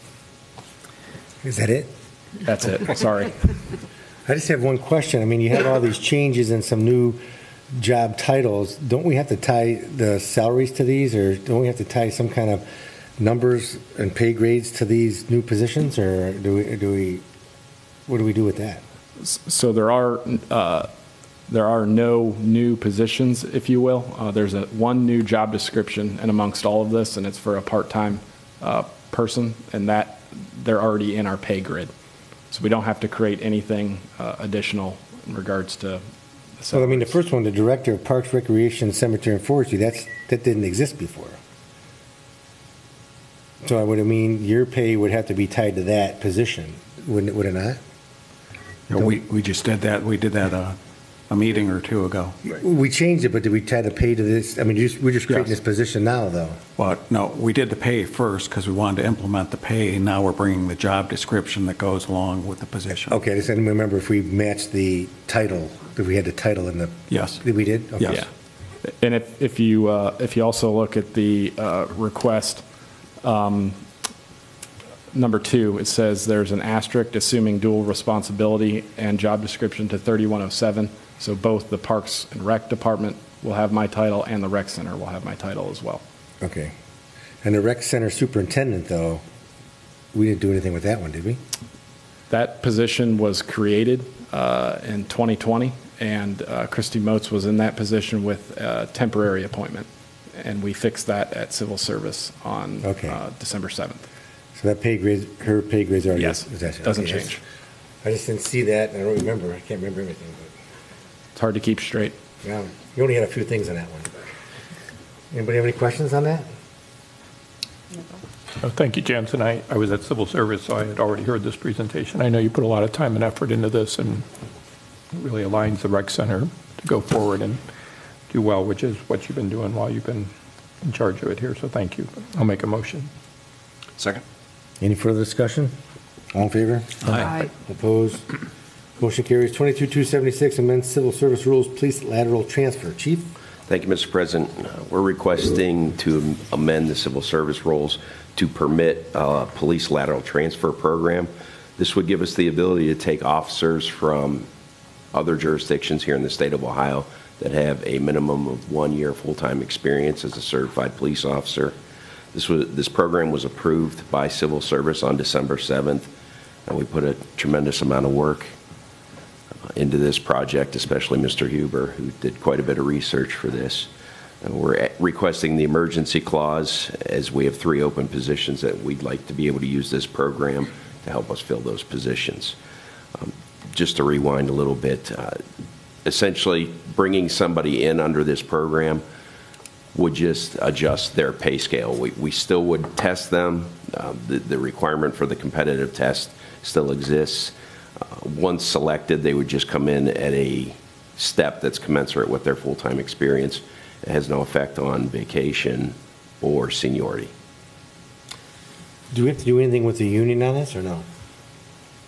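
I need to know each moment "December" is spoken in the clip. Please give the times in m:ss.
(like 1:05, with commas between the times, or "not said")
1:43, 2:45.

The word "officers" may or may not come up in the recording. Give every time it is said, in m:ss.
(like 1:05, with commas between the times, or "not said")
2:33, 2:41.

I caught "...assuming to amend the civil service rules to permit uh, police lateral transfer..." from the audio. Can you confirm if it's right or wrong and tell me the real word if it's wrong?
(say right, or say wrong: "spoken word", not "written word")
wrong: "requesting", not "assuming".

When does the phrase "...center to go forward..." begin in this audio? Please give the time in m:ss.
2:06.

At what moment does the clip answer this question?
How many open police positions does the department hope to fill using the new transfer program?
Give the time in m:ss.
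2:57.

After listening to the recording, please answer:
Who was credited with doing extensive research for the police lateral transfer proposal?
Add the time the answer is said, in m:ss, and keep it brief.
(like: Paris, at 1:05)
Mr. Huber, at 2:51.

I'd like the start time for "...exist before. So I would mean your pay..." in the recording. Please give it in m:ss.
0:40.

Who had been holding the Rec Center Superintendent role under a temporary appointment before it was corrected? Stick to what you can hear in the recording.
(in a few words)
Christy Moats.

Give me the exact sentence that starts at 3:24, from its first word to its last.
It has no effect on vacation or seniority.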